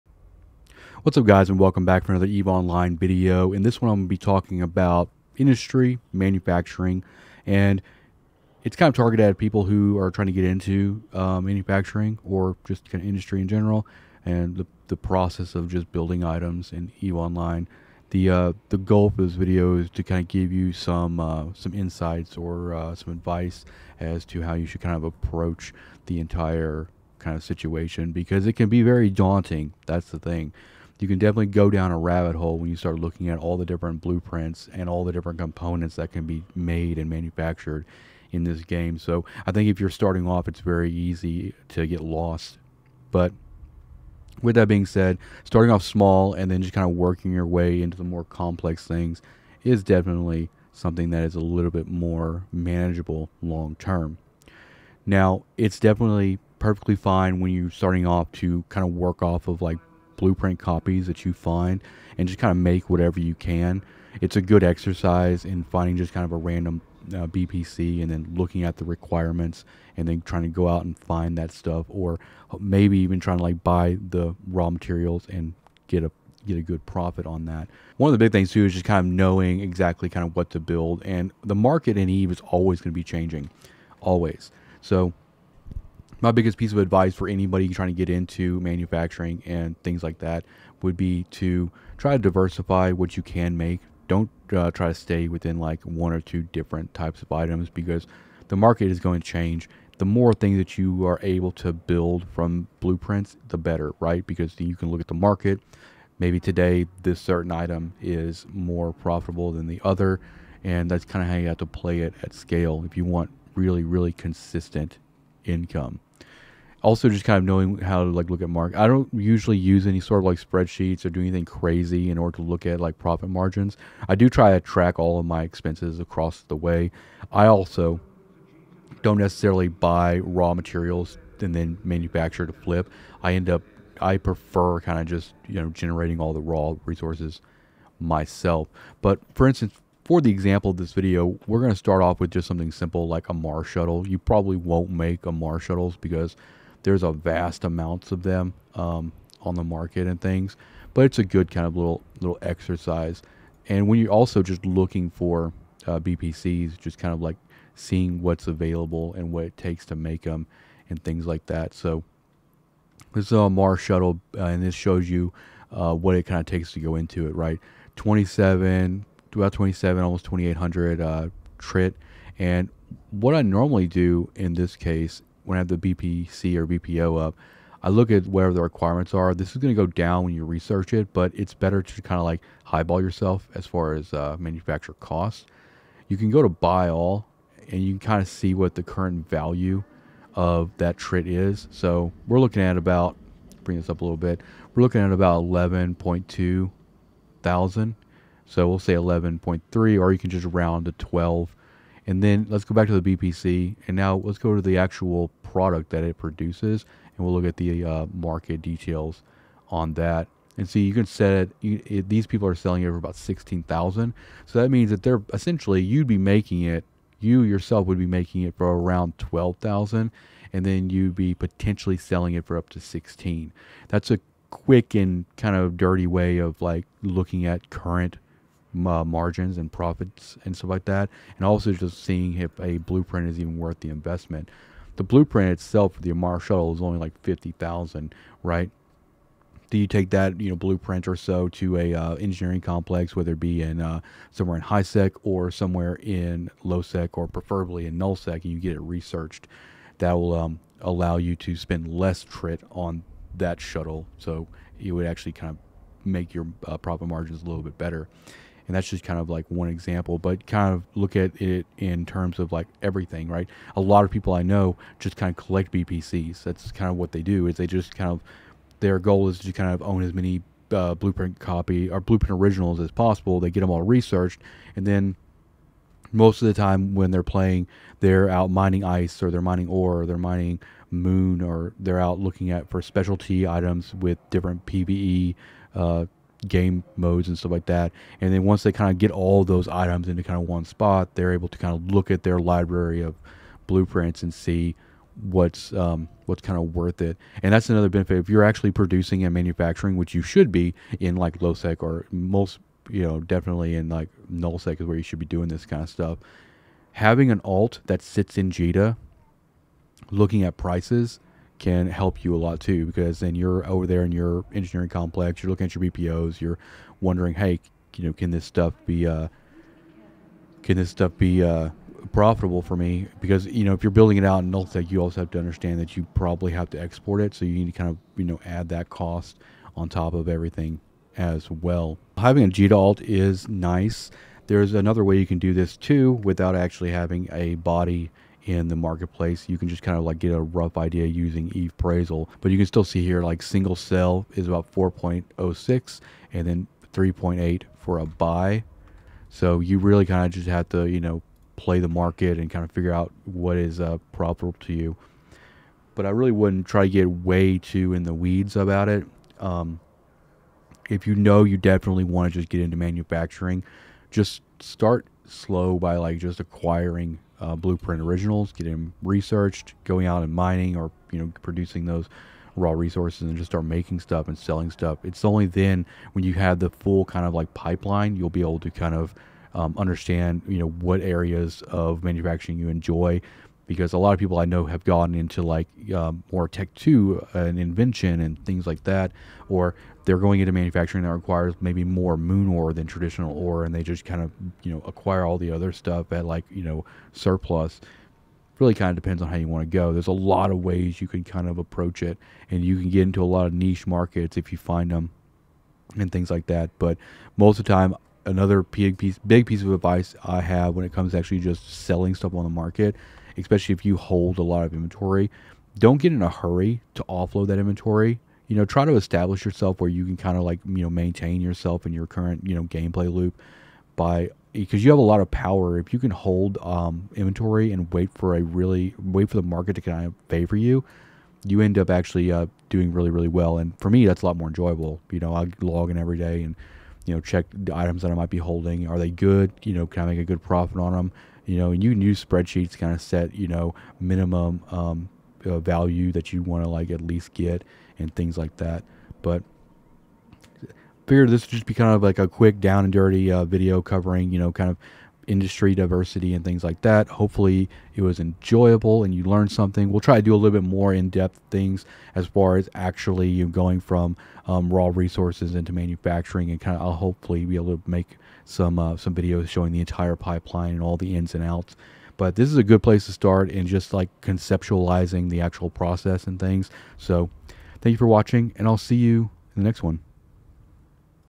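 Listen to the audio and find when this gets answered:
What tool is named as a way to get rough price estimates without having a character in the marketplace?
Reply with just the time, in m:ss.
5:41.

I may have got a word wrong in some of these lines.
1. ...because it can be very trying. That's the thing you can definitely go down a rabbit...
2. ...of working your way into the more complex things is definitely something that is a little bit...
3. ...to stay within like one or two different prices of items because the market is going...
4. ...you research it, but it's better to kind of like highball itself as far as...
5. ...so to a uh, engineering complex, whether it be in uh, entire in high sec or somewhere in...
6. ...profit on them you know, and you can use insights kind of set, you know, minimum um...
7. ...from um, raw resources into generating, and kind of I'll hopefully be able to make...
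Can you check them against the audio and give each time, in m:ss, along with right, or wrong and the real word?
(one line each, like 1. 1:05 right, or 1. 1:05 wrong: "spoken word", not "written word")
1. 0:28 wrong: "daunting", not "trying"
2. 0:46 right
3. 1:34 wrong: "types", not "prices"
4. 3:00 wrong: "yourself", not "itself"
5. 4:01 wrong: "somewhere", not "entire"
6. 7:20 wrong: "spreadsheets", not "insights"
7. 7:43 wrong: "manufacturing", not "generating".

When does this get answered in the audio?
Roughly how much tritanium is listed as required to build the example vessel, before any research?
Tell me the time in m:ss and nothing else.
2:50.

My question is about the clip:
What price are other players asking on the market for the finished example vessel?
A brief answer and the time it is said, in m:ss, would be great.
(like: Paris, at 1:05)
about 16,000, at 3:32.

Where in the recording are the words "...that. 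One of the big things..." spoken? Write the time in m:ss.
1:17.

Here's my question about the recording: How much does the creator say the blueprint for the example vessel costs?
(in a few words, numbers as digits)
50,000.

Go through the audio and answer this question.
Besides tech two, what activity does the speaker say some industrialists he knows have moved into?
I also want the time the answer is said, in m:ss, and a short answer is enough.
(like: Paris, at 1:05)
invention, at 6:27.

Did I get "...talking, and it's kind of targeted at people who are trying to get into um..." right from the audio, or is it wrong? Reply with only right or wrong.
wrong.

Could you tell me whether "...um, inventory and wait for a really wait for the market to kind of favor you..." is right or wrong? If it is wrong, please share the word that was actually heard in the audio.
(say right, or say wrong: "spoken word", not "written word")
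right.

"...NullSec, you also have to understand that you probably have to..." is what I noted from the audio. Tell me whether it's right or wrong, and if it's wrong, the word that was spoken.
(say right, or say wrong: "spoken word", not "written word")
right.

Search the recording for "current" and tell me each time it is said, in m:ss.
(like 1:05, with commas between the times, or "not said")
3:08, 3:47, 7:02.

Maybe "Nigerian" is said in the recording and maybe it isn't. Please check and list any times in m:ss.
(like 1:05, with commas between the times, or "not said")
not said.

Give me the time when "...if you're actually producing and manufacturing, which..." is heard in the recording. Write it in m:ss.
4:58.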